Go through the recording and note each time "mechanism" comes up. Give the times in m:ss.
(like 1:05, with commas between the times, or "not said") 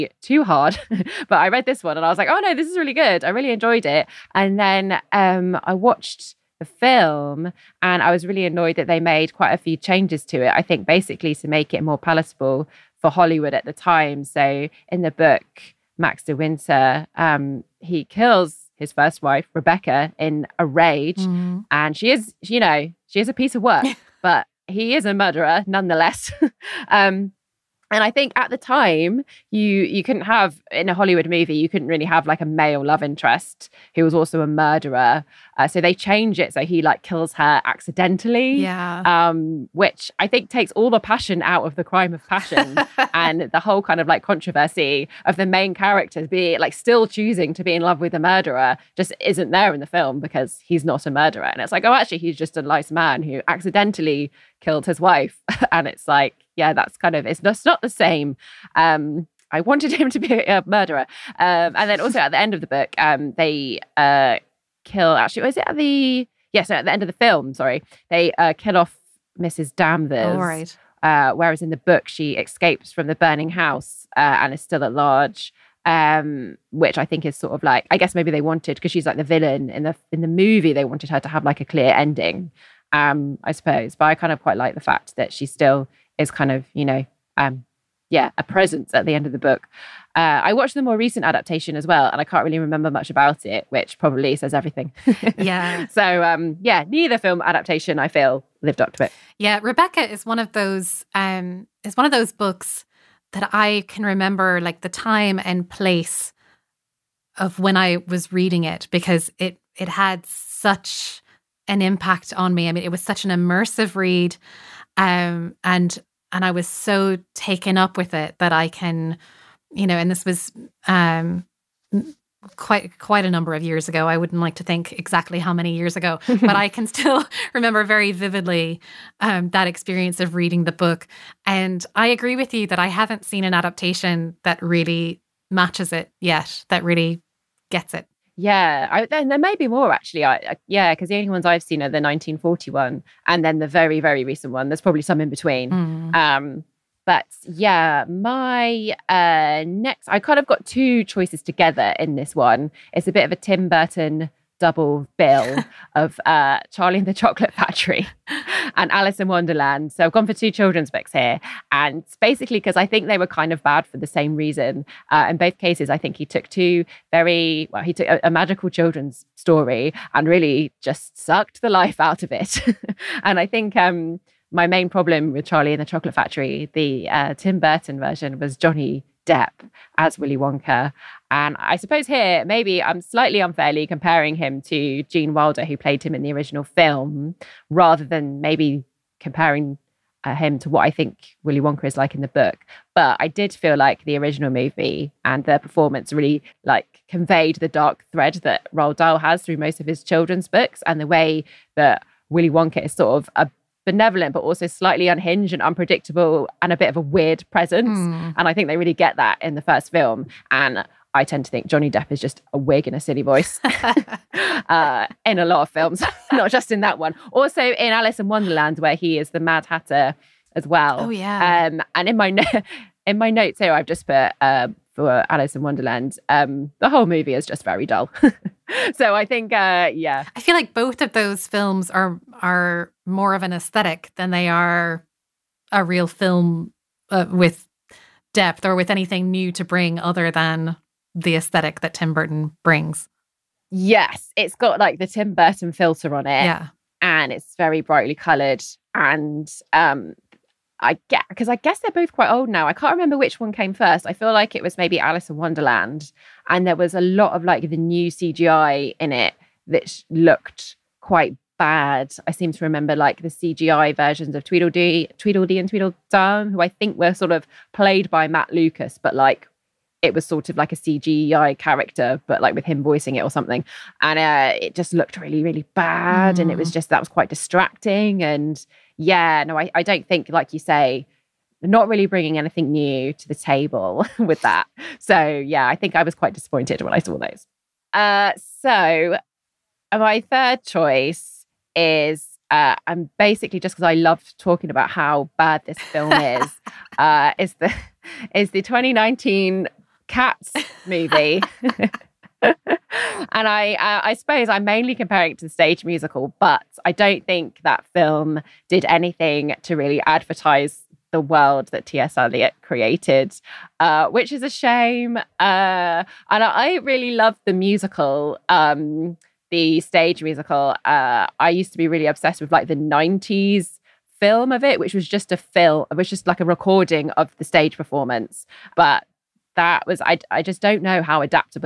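not said.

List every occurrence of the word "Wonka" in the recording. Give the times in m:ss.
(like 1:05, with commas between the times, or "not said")
3:00, 3:11, 3:22.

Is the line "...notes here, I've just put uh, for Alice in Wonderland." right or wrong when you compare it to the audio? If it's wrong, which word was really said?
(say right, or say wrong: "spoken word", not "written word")
right.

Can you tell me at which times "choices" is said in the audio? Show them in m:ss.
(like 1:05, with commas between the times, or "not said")
2:31, 4:50.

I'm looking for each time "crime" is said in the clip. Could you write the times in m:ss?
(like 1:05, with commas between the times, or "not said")
0:41.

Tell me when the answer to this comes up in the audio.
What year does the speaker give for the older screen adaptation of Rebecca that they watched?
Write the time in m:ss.
2:22.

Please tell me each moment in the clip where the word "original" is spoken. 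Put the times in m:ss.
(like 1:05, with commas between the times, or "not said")
3:06, 3:14.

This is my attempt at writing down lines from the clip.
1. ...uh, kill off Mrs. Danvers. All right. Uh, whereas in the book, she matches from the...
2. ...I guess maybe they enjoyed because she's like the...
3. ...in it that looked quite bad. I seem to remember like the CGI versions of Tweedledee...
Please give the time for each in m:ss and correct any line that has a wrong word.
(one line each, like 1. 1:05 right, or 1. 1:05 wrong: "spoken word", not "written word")
1. 1:08 wrong: "escapes", not "matches"
2. 1:17 wrong: "wanted", not "enjoyed"
3. 4:18 right.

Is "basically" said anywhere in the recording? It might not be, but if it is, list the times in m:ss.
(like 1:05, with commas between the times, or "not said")
0:10, 2:42, 4:53.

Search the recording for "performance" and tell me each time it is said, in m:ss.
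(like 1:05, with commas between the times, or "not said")
3:15, 5:27.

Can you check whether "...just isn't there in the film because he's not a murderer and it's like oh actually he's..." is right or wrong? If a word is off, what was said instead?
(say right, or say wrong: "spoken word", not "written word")
right.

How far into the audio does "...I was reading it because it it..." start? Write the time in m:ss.
1:47.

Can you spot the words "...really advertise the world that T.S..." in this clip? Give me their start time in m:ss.
5:09.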